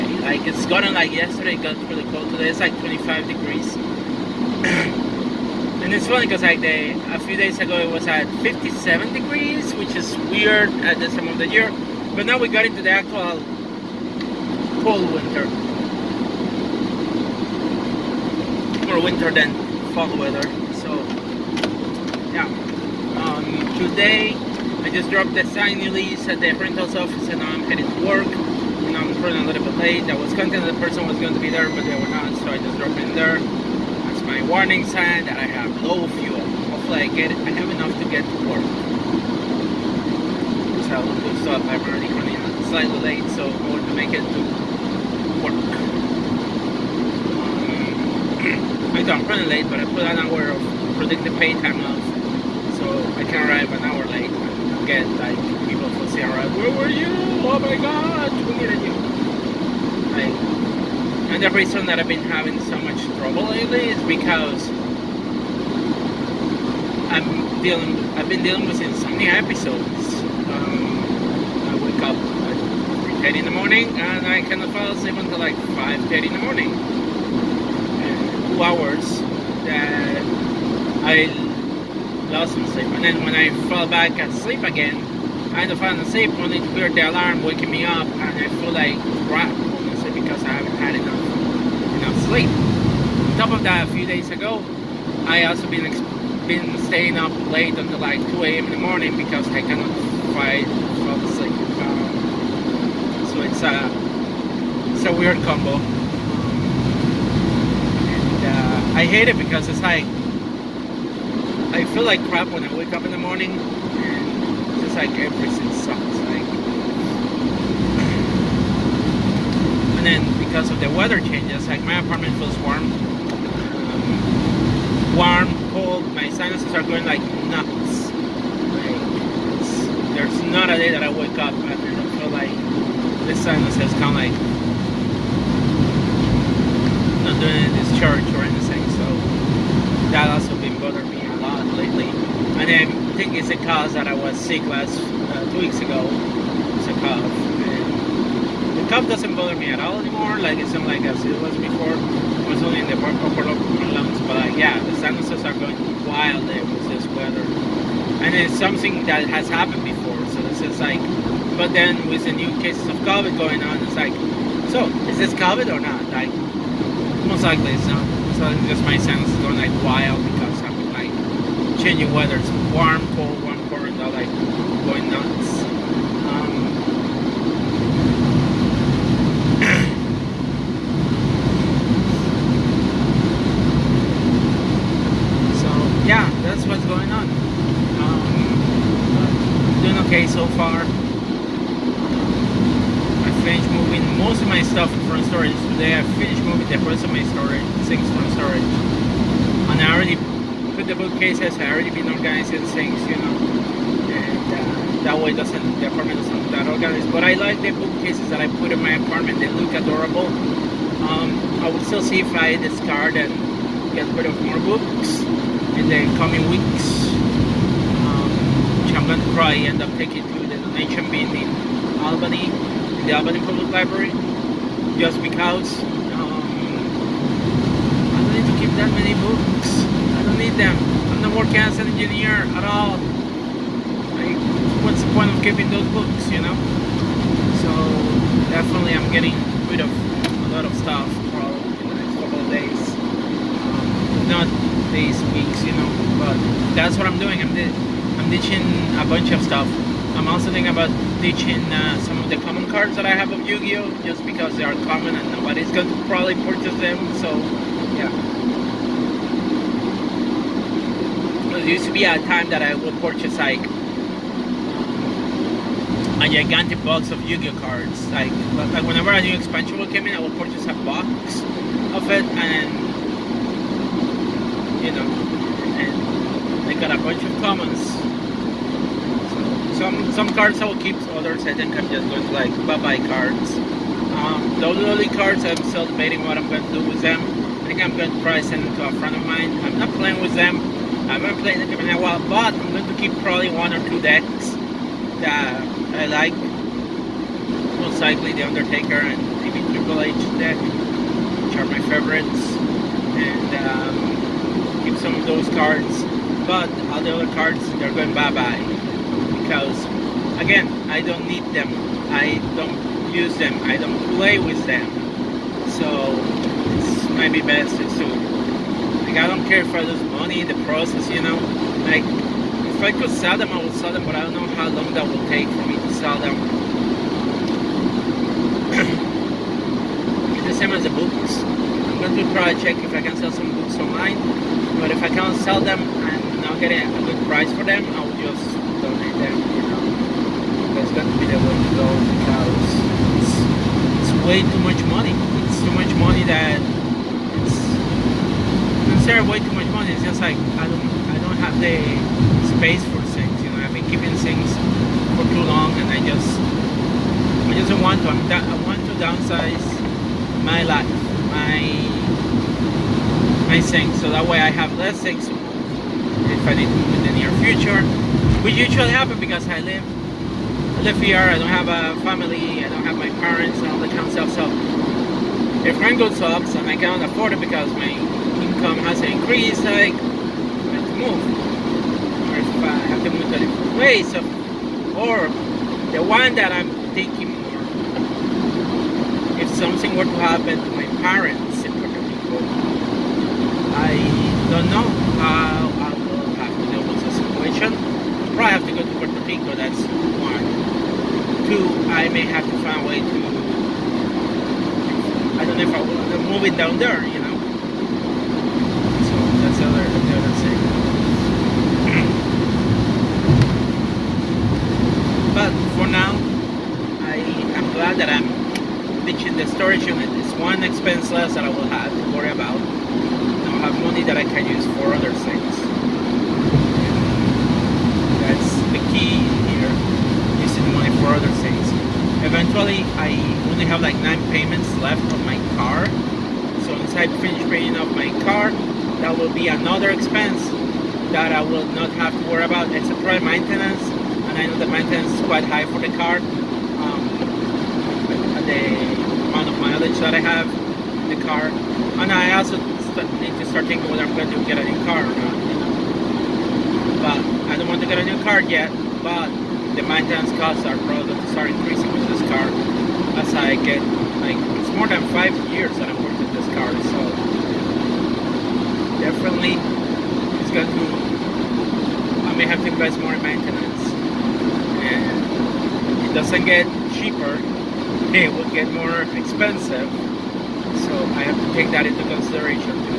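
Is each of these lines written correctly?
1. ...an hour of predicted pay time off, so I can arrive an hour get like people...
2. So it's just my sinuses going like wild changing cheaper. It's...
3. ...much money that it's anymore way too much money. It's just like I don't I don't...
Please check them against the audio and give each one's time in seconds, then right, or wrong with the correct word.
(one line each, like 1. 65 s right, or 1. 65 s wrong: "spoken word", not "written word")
1. 50 s right
2. 168 s wrong: "weather", not "cheaper"
3. 345 s wrong: "share", not "anymore".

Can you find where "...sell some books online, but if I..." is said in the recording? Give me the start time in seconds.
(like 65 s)
333 s.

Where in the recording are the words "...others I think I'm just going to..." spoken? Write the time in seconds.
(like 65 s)
281 s.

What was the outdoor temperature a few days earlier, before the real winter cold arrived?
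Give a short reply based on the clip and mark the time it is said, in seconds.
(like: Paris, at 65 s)
57 degrees, at 8 s.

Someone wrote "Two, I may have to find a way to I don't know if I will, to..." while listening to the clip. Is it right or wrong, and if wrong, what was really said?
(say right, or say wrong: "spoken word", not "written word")
right.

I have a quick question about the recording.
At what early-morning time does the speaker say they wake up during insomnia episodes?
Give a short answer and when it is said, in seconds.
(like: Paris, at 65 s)
3:30, at 73 s.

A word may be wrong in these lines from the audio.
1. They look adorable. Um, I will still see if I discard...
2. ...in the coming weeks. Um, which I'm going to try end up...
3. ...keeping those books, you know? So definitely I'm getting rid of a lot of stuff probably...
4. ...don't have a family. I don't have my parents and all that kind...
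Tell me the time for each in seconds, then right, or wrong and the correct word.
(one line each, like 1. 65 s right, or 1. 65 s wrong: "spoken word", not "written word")
1. 209 s right
2. 215 s right
3. 235 s right
4. 371 s right.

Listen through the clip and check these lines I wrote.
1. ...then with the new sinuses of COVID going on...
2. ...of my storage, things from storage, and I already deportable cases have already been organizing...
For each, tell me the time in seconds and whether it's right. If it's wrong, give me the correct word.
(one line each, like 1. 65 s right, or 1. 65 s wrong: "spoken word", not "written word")
1. 161 s wrong: "cases", not "sinuses"
2. 197 s right.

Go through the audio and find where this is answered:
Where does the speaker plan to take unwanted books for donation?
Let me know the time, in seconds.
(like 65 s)
223 s.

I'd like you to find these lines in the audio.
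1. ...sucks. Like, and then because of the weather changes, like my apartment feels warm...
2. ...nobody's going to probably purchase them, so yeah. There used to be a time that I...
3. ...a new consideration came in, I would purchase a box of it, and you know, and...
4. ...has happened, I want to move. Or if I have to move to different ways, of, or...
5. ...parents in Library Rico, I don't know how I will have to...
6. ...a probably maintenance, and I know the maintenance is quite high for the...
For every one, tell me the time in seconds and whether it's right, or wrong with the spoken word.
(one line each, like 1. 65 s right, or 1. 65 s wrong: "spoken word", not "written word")
1. 115 s right
2. 255 s right
3. 269 s wrong: "expansion", not "consideration"
4. 378 s wrong: "increased", not "happened"
5. 391 s wrong: "Puerto", not "Library"
6. 442 s right.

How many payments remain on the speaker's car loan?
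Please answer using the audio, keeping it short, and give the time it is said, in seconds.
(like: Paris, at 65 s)
9, at 434 s.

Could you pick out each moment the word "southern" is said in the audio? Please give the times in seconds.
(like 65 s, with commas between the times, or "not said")
not said.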